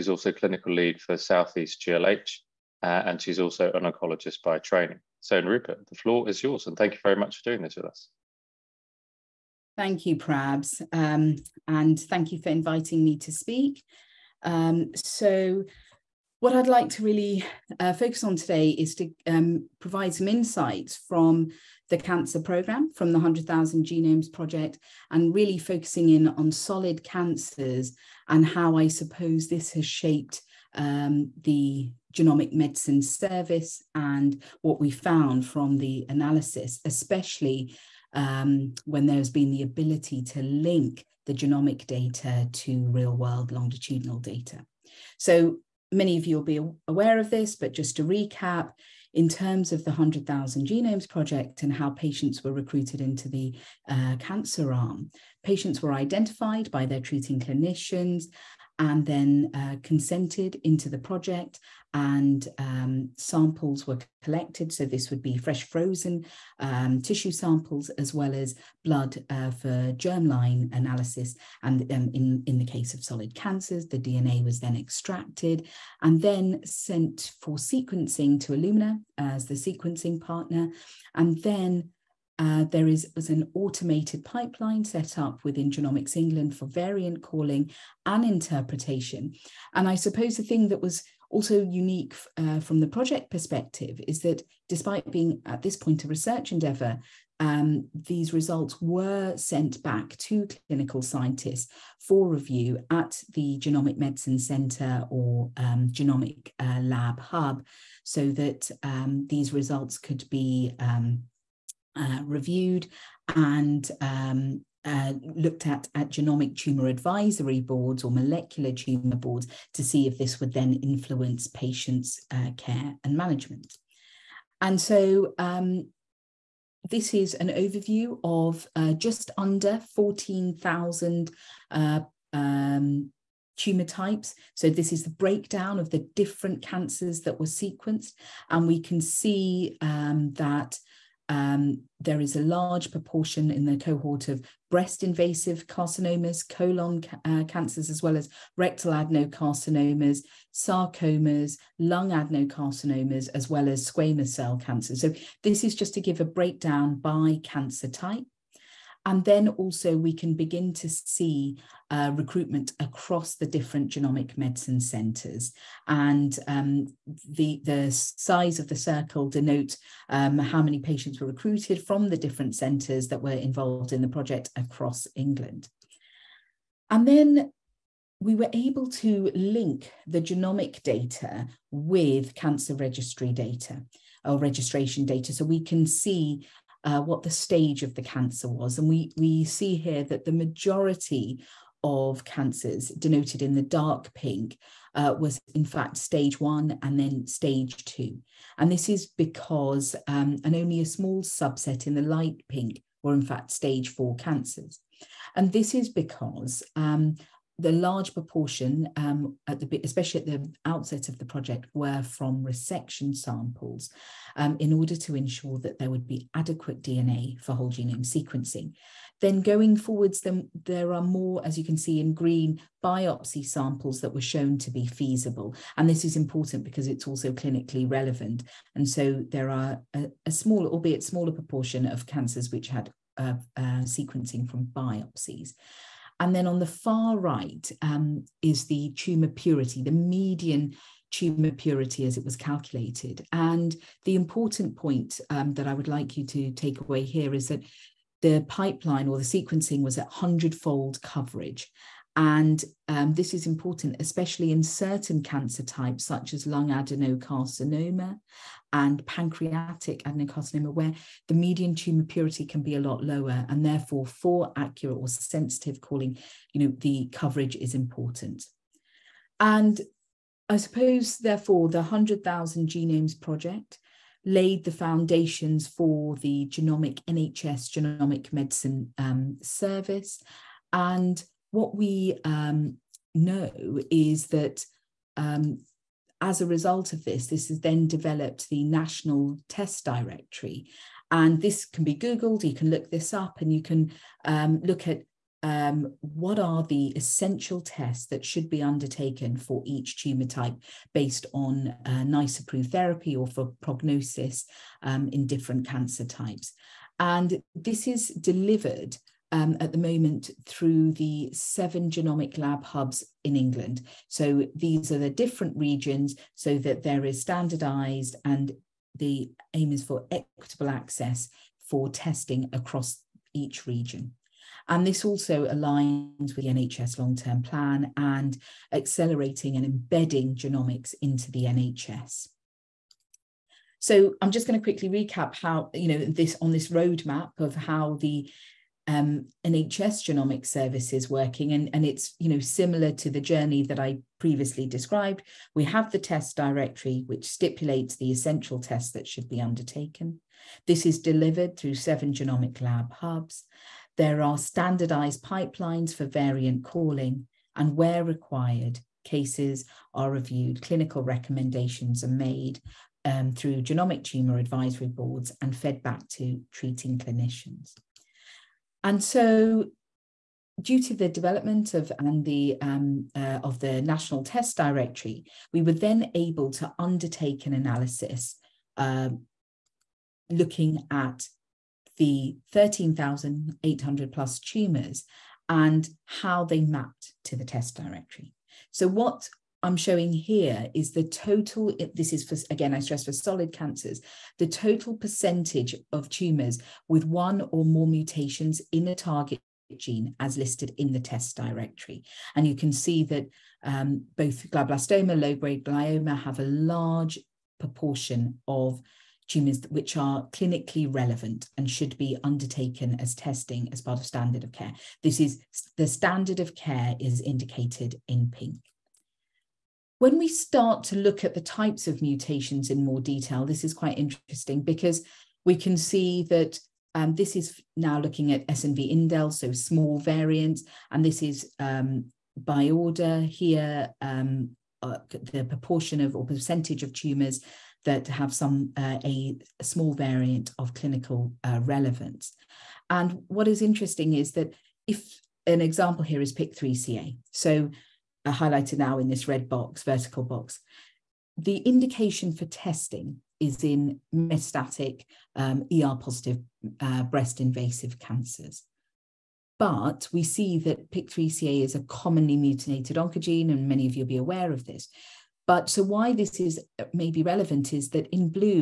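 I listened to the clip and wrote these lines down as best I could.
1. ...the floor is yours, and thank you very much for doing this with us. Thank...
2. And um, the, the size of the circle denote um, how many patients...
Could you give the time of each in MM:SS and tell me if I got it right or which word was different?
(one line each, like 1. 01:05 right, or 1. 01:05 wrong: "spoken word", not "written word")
1. 00:05 right
2. 02:45 right.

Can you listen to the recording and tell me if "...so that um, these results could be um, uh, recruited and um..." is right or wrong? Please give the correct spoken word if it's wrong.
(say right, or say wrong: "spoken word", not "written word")
wrong: "reviewed", not "recruited".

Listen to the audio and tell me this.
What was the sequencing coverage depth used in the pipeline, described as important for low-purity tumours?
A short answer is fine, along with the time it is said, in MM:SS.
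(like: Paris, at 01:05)
100 fold, at 04:10.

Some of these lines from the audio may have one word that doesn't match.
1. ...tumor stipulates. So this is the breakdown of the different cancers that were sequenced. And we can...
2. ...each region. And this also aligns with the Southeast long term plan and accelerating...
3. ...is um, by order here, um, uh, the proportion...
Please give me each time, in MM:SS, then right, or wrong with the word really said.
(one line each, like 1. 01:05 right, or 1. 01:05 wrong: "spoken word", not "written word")
1. 02:13 wrong: "types", not "stipulates"
2. 05:23 wrong: "NHS", not "Southeast"
3. 07:11 right.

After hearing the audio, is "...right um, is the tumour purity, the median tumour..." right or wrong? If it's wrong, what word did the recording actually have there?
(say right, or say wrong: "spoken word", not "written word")
right.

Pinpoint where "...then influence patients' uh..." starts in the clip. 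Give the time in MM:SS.
02:00.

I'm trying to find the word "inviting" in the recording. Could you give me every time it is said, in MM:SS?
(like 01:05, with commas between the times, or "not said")
00:12.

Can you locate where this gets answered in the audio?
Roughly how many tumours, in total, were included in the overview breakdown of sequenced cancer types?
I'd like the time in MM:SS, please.
02:08.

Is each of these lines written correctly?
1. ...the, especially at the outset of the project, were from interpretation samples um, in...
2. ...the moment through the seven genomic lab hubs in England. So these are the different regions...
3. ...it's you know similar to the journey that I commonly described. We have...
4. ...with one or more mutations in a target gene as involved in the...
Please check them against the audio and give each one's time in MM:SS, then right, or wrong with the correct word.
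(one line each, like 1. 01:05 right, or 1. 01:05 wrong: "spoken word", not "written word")
1. 03:29 wrong: "resection", not "interpretation"
2. 05:09 right
3. 05:41 wrong: "previously", not "commonly"
4. 06:36 wrong: "listed", not "involved".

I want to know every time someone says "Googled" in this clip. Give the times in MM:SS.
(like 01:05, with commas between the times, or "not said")
04:51.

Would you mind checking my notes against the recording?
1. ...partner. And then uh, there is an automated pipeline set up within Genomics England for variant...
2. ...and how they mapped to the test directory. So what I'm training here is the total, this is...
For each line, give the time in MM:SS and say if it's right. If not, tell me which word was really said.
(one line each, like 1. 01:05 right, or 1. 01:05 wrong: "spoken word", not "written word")
1. 01:20 right
2. 06:25 wrong: "showing", not "training".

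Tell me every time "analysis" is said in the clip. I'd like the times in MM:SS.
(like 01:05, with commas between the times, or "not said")
00:36, 01:10, 06:17.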